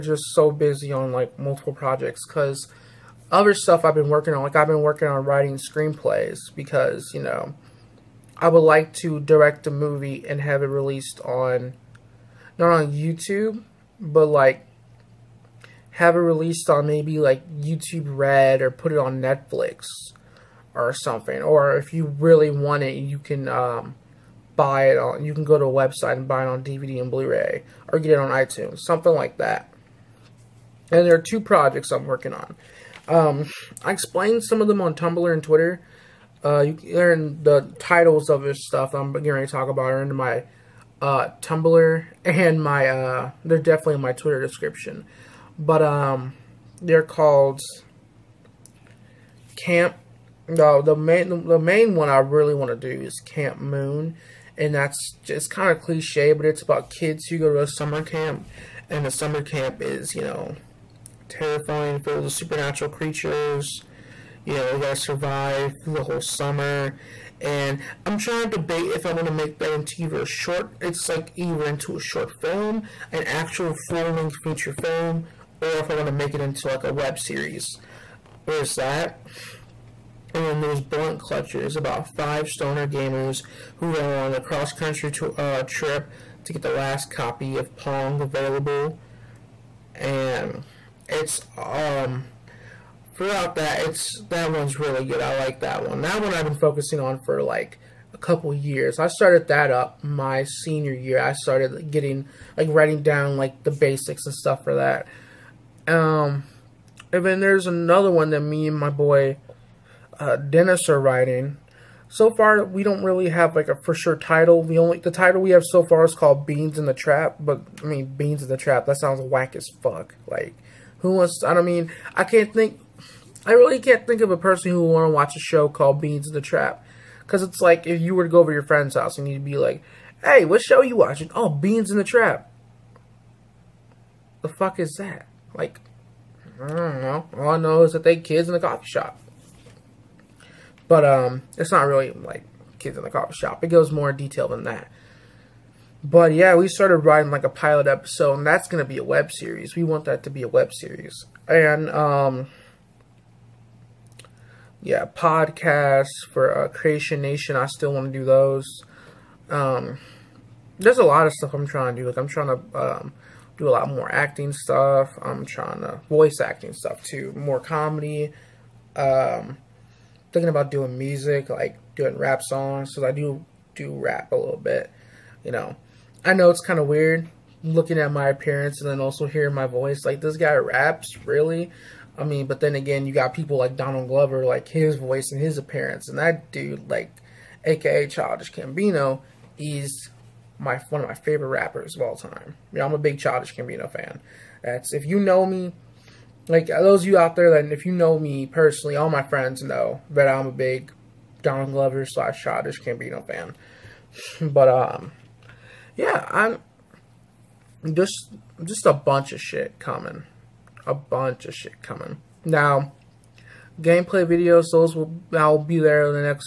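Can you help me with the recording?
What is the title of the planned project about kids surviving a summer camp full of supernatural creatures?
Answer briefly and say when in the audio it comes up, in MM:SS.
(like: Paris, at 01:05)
Camp Moon, at 00:53.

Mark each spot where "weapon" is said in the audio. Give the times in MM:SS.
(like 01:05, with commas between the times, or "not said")
not said.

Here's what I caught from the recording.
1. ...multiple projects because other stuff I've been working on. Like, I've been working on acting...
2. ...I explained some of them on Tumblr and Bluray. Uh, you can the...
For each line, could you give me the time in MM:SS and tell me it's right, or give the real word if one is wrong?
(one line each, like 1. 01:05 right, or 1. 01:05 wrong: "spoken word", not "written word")
1. 00:01 wrong: "writing", not "acting"
2. 00:33 wrong: "Twitter", not "Bluray".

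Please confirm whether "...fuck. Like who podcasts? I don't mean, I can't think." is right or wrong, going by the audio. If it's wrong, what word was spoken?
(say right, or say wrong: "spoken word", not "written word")
wrong: "wants", not "podcasts".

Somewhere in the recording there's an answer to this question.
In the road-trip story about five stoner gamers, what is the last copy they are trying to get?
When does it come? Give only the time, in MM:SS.
01:27.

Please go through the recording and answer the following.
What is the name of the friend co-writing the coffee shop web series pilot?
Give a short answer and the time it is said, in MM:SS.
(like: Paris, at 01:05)
Dennis, at 01:50.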